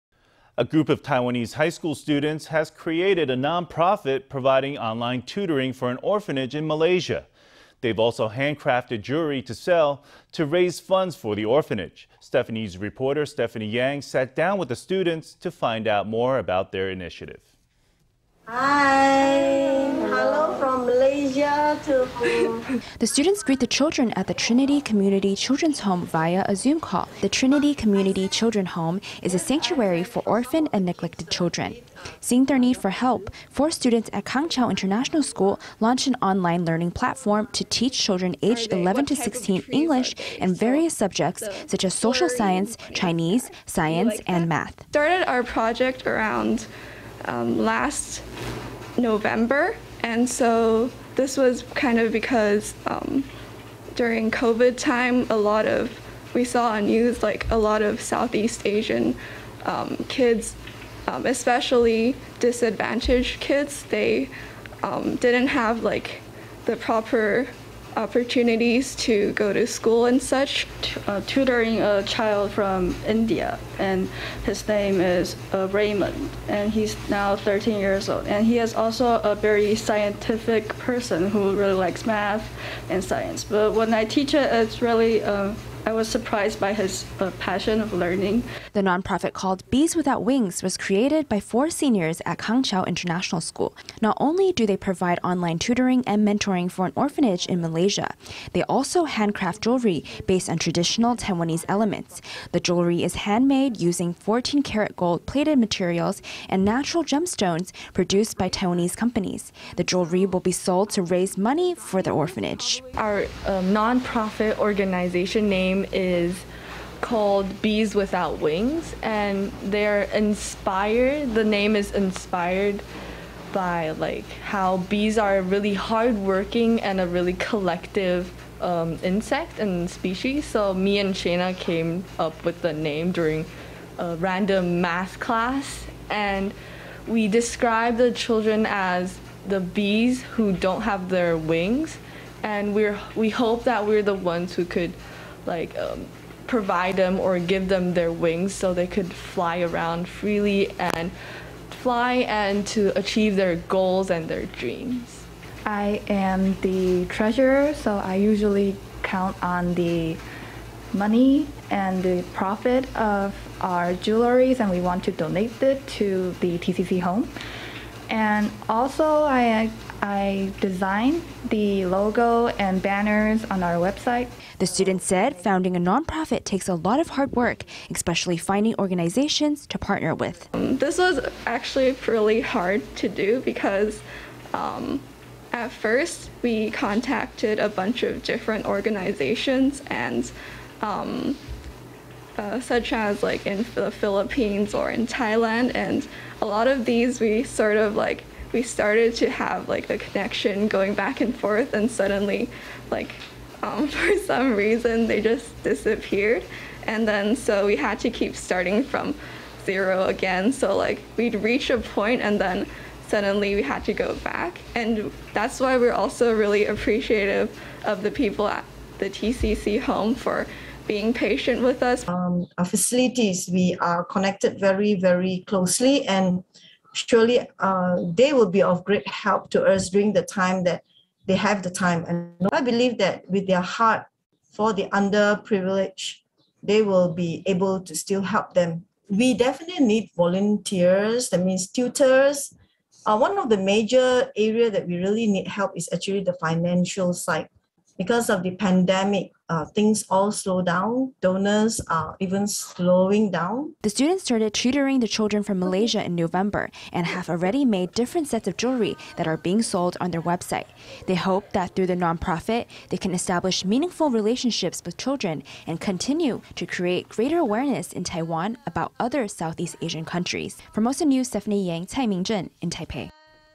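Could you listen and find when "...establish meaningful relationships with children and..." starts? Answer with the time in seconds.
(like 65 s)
263 s.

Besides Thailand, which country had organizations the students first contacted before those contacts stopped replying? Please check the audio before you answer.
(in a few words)
Philippines.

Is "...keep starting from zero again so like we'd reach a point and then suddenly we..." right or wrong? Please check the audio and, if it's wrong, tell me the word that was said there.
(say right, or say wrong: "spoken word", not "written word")
right.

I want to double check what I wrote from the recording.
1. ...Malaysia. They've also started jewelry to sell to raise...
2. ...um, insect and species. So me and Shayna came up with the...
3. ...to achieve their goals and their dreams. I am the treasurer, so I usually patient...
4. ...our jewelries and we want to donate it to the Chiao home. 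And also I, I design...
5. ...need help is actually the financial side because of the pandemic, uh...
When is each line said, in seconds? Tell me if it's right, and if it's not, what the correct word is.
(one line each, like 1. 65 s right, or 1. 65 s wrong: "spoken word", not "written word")
1. 6 s wrong: "handcrafted", not "started"
2. 128 s right
3. 152 s wrong: "count", not "patient"
4. 163 s wrong: "TCC", not "Chiao"
5. 245 s right.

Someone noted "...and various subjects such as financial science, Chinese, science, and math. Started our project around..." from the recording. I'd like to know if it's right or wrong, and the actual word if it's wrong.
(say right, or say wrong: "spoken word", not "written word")
wrong: "social", not "financial".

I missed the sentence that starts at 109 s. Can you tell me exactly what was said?
The jewelry will be sold to raise money for the orphanage.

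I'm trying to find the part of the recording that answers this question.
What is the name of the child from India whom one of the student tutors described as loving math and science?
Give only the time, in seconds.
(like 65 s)
75 s.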